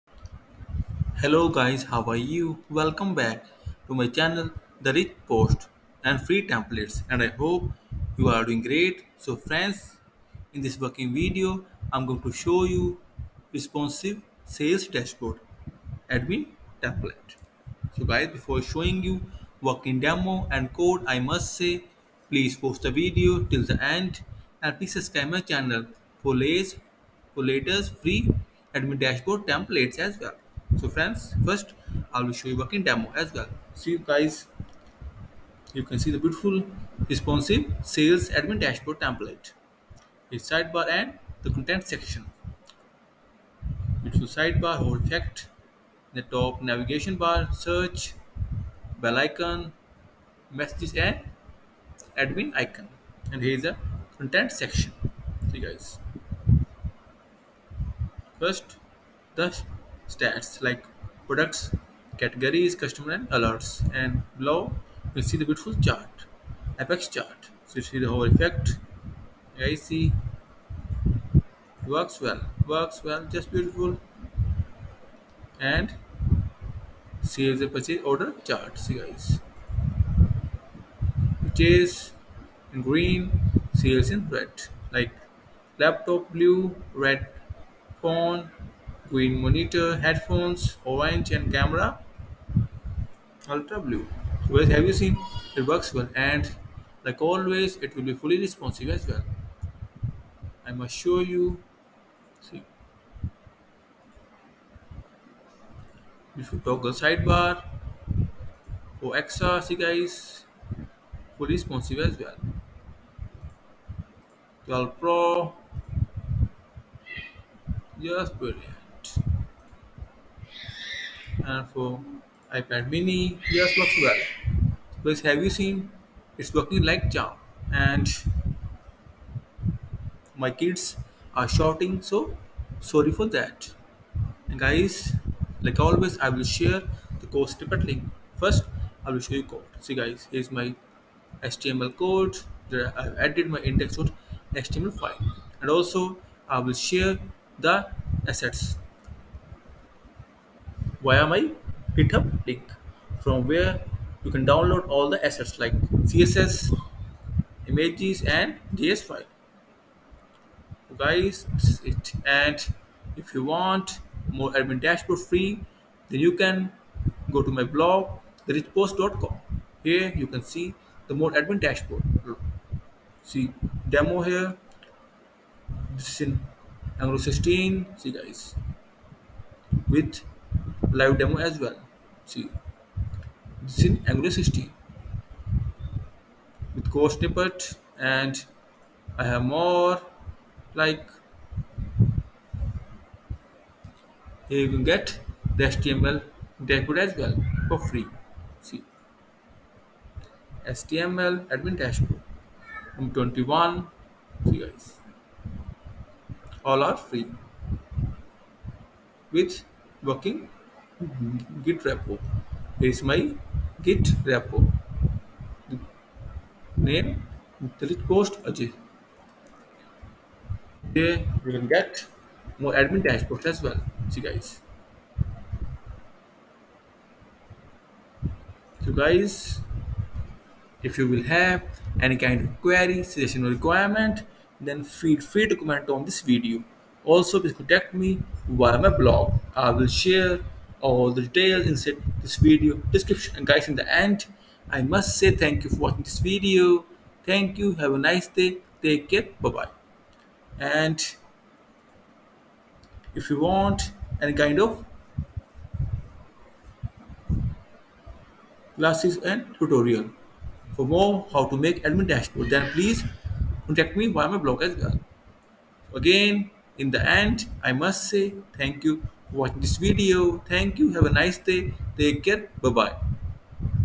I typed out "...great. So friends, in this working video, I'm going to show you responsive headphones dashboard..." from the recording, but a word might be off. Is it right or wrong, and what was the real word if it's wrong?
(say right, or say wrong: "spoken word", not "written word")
wrong: "sales", not "headphones".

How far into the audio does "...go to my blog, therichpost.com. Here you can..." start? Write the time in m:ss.
2:47.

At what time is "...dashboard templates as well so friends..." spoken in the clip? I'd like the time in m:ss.
0:28.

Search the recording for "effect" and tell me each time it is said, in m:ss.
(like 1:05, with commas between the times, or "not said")
0:44, 1:08.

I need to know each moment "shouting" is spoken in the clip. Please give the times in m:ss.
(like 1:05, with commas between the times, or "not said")
2:11.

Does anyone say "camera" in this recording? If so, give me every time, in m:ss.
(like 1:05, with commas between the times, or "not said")
1:31.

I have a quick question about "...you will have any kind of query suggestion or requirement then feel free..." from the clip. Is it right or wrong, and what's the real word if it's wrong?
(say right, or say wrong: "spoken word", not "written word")
right.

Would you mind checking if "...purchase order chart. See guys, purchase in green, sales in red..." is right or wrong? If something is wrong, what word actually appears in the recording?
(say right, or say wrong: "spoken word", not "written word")
right.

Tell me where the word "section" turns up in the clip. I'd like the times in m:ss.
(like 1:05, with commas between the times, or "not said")
0:41, 0:54.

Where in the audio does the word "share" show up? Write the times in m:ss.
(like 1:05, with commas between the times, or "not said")
2:16, 2:26, 4:00.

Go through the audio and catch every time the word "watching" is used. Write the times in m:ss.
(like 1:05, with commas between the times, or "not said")
4:05, 4:29.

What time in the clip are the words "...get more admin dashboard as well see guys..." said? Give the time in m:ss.
3:41.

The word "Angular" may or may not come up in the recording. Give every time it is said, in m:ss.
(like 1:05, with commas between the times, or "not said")
2:56, 3:04.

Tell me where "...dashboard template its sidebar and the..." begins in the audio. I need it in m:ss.
0:38.